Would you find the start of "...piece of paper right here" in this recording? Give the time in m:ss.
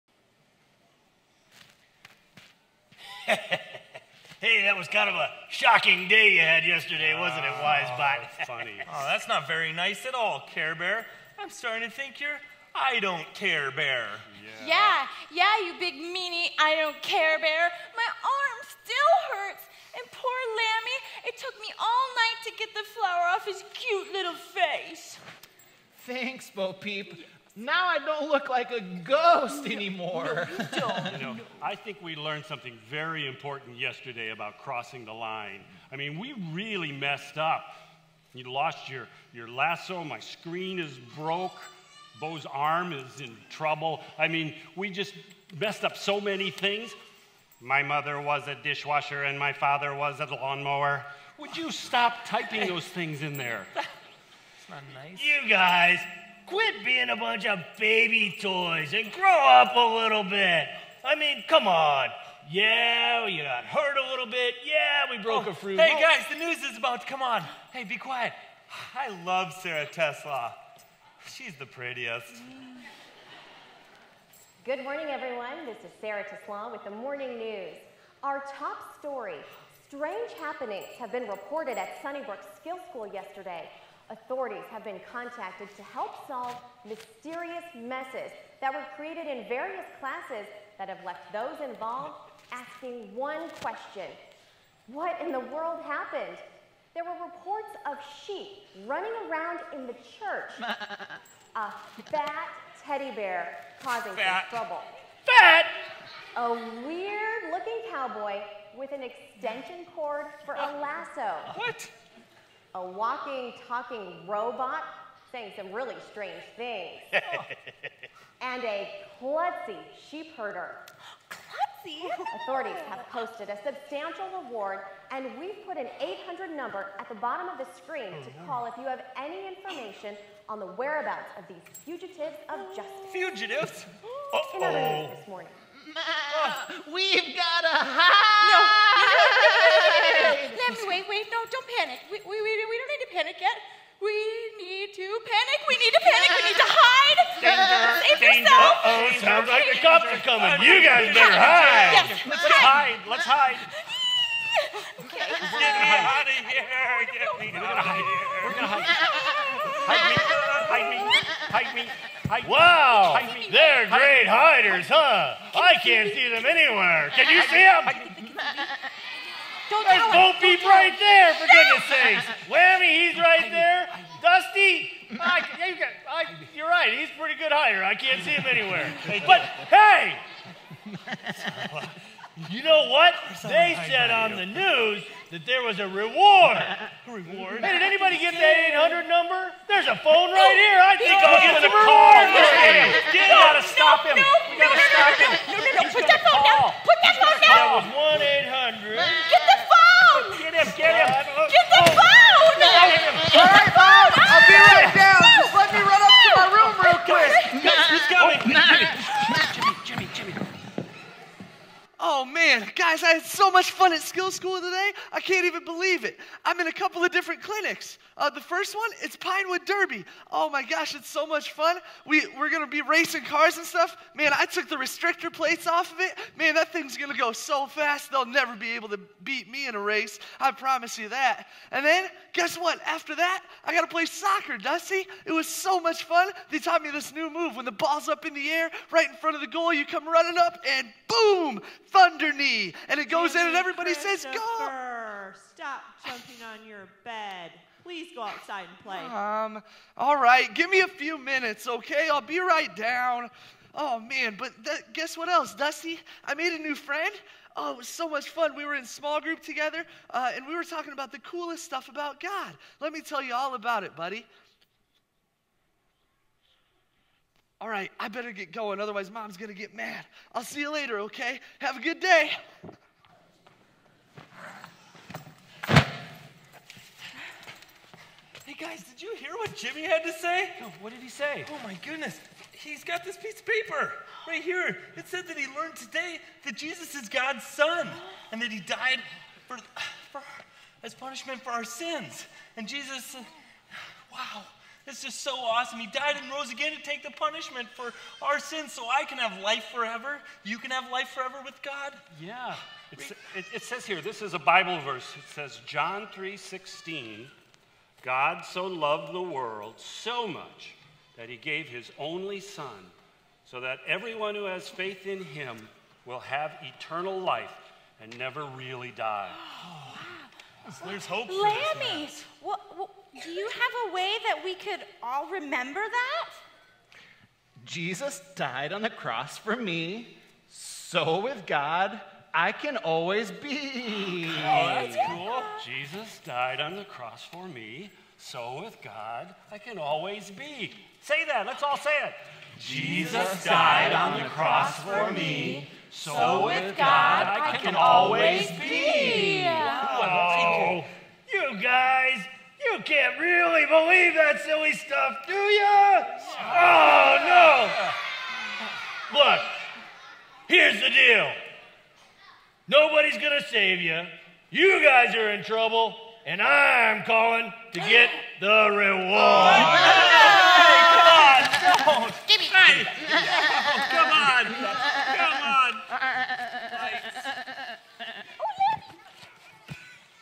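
4:43.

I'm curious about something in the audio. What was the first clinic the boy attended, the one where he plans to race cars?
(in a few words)
Pinewood Derby.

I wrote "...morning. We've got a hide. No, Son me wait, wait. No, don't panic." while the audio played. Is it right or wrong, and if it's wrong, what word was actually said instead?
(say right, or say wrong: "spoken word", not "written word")
wrong: "Let", not "Son".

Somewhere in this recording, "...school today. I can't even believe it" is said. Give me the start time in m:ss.
3:34.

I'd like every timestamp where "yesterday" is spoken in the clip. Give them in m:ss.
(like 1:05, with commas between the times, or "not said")
0:06, 0:33, 1:23.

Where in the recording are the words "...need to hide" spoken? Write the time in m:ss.
2:26.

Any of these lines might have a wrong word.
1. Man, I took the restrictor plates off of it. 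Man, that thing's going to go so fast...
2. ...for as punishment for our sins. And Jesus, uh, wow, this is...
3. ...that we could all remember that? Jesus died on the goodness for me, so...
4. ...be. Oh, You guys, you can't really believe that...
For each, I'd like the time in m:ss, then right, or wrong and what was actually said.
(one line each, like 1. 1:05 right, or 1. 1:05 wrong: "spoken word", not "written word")
1. 3:44 right
2. 4:50 right
3. 5:24 wrong: "cross", not "goodness"
4. 5:48 right.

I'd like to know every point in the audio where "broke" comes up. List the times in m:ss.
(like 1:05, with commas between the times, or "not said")
0:41, 1:05.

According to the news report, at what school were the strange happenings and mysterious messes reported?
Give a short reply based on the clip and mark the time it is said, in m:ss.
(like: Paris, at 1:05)
Sunnybrook Skill School, at 1:22.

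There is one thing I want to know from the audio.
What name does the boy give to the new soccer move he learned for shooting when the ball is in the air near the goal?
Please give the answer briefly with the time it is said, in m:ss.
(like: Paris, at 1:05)
Thunder knee, at 4:01.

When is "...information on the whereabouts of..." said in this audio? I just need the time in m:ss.
2:09.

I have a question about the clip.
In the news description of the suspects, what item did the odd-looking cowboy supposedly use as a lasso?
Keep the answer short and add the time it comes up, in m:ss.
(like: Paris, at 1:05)
An extension cord, at 1:49.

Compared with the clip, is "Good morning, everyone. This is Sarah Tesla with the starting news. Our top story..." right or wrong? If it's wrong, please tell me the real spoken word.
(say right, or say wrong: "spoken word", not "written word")
wrong: "morning", not "starting".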